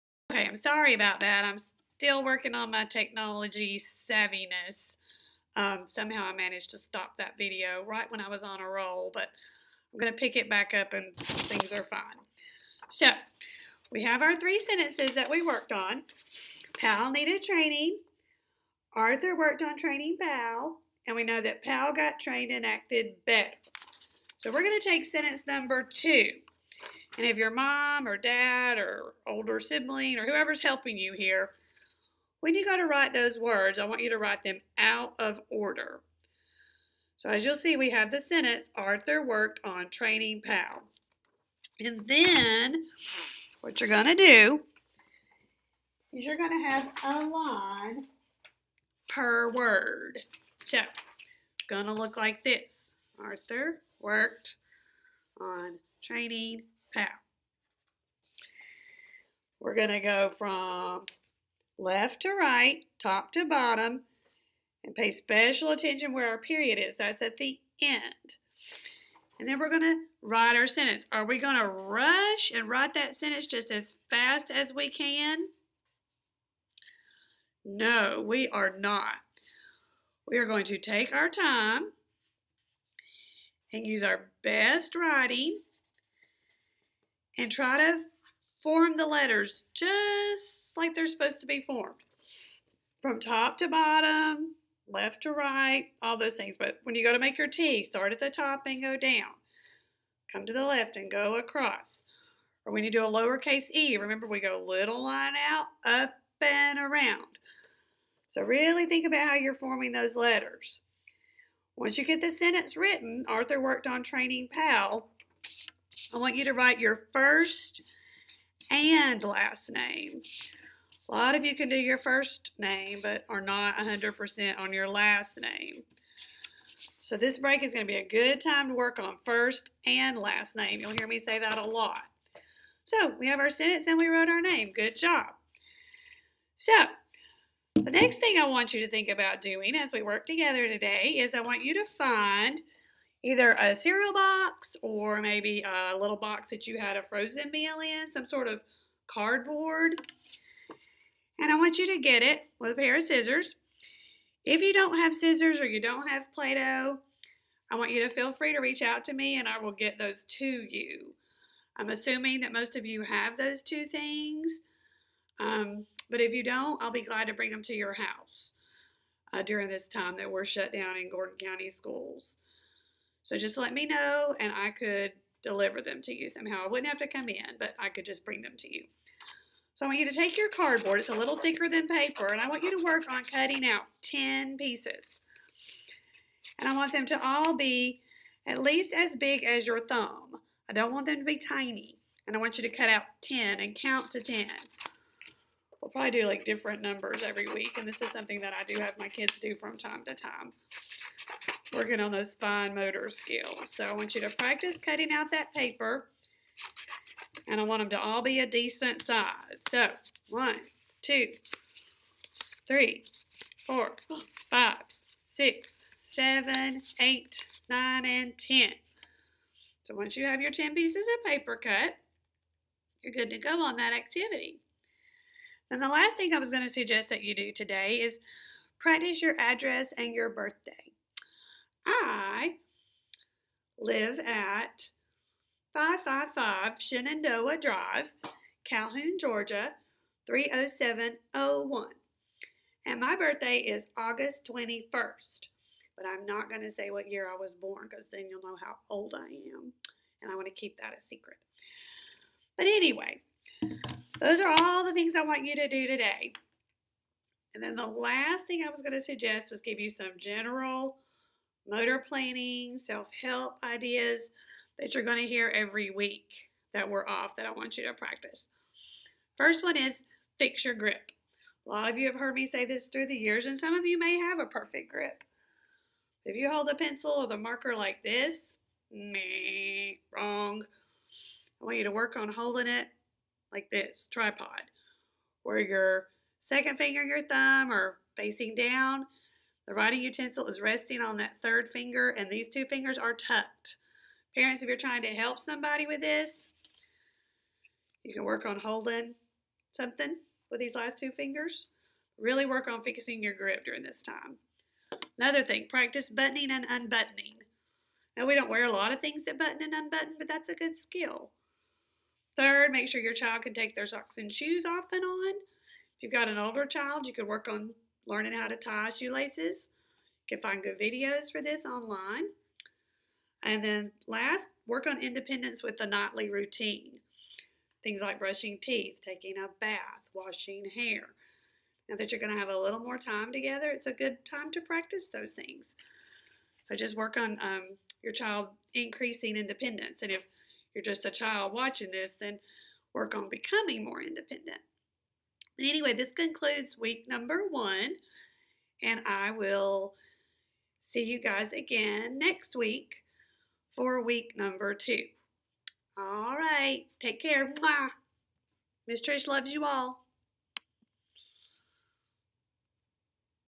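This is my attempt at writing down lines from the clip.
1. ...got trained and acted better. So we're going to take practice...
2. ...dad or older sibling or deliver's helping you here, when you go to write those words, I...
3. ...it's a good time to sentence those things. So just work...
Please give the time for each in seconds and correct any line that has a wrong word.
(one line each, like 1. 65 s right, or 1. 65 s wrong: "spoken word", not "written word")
1. 21 s wrong: "sentence", not "practice"
2. 28 s wrong: "whoever", not "deliver"
3. 333 s wrong: "practice", not "sentence".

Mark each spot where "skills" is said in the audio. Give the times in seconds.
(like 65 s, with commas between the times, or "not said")
203 s, 310 s.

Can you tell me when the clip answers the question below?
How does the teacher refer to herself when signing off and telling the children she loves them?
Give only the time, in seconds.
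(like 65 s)
358 s.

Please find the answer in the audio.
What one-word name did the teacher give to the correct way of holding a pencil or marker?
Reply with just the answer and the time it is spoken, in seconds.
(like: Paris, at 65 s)
tripod, at 284 s.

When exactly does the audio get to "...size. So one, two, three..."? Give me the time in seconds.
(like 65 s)
209 s.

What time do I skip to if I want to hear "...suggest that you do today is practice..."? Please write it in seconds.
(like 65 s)
226 s.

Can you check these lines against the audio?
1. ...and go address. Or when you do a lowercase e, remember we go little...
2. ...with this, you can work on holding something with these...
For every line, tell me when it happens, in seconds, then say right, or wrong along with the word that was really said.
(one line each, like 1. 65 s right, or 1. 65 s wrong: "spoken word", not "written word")
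1. 100 s wrong: "across", not "address"
2. 295 s right.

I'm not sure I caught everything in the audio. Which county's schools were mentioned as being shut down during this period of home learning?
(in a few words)
Gordon County.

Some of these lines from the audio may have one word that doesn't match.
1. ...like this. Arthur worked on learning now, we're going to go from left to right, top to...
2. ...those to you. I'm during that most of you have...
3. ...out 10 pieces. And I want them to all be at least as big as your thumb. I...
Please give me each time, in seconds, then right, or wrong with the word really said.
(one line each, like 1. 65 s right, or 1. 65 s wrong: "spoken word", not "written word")
1. 52 s wrong: "training", not "learning"
2. 159 s wrong: "assuming", not "during"
3. 183 s right.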